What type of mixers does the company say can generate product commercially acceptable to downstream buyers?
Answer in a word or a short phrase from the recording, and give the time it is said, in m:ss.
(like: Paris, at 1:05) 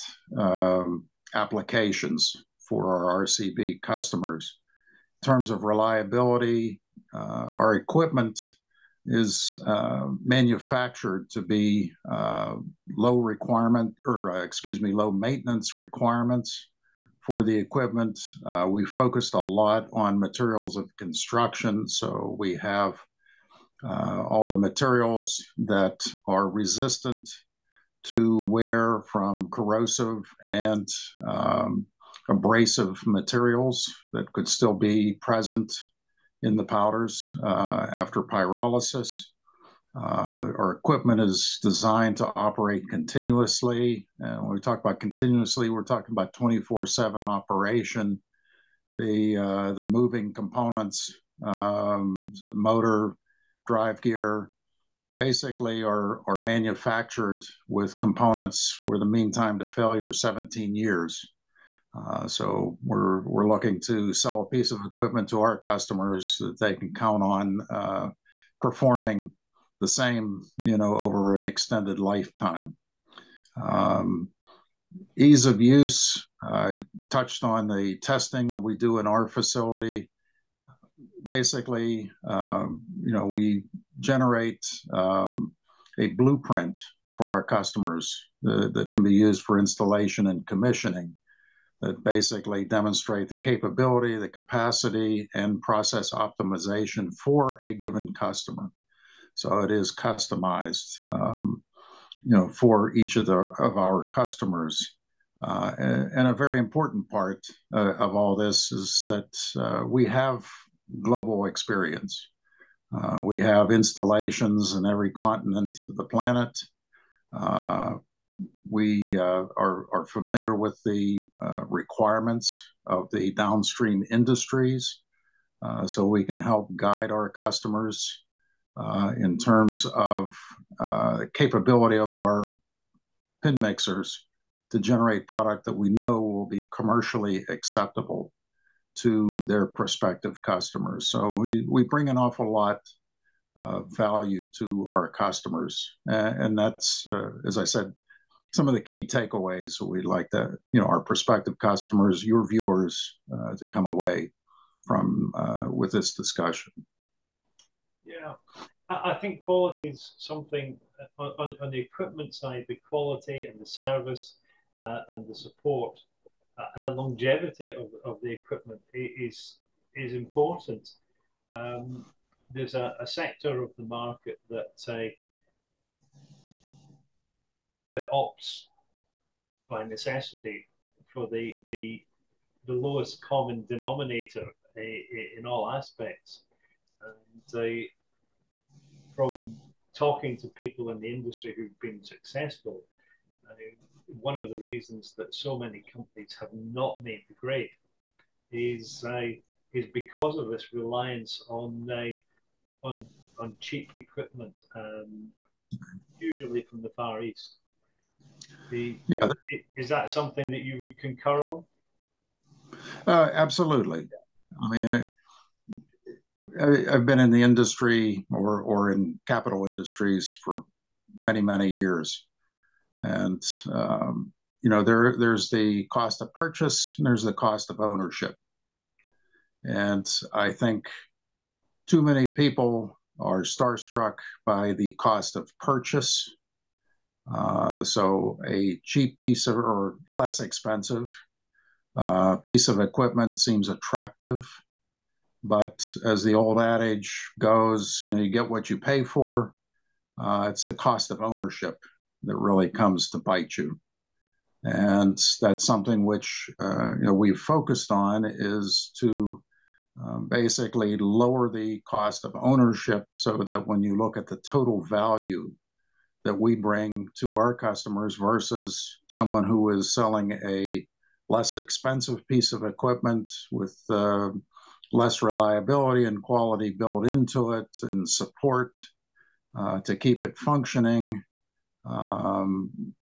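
pin mixers, at 2:13.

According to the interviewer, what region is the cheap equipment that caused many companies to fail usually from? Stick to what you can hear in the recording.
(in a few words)
Far East.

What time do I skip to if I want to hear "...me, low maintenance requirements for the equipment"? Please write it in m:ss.
0:14.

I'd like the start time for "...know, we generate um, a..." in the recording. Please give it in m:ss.
1:23.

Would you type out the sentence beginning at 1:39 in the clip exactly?
So it is customized, um, you know, for each of the of our customers.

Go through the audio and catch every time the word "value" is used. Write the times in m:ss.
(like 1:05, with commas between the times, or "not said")
2:23, 4:24.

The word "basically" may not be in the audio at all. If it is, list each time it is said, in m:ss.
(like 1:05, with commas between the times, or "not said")
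0:55, 1:21, 1:32, 4:20.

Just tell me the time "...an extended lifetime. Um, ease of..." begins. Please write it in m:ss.
1:11.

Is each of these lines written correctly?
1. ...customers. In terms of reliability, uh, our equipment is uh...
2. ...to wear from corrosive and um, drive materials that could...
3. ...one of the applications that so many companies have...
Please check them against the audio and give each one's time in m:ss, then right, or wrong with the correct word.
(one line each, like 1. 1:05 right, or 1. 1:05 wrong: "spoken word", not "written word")
1. 0:03 right
2. 0:28 wrong: "abrasive", not "drive"
3. 3:14 wrong: "reasons", not "applications".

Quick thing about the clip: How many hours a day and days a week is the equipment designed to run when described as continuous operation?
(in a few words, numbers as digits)
24/7.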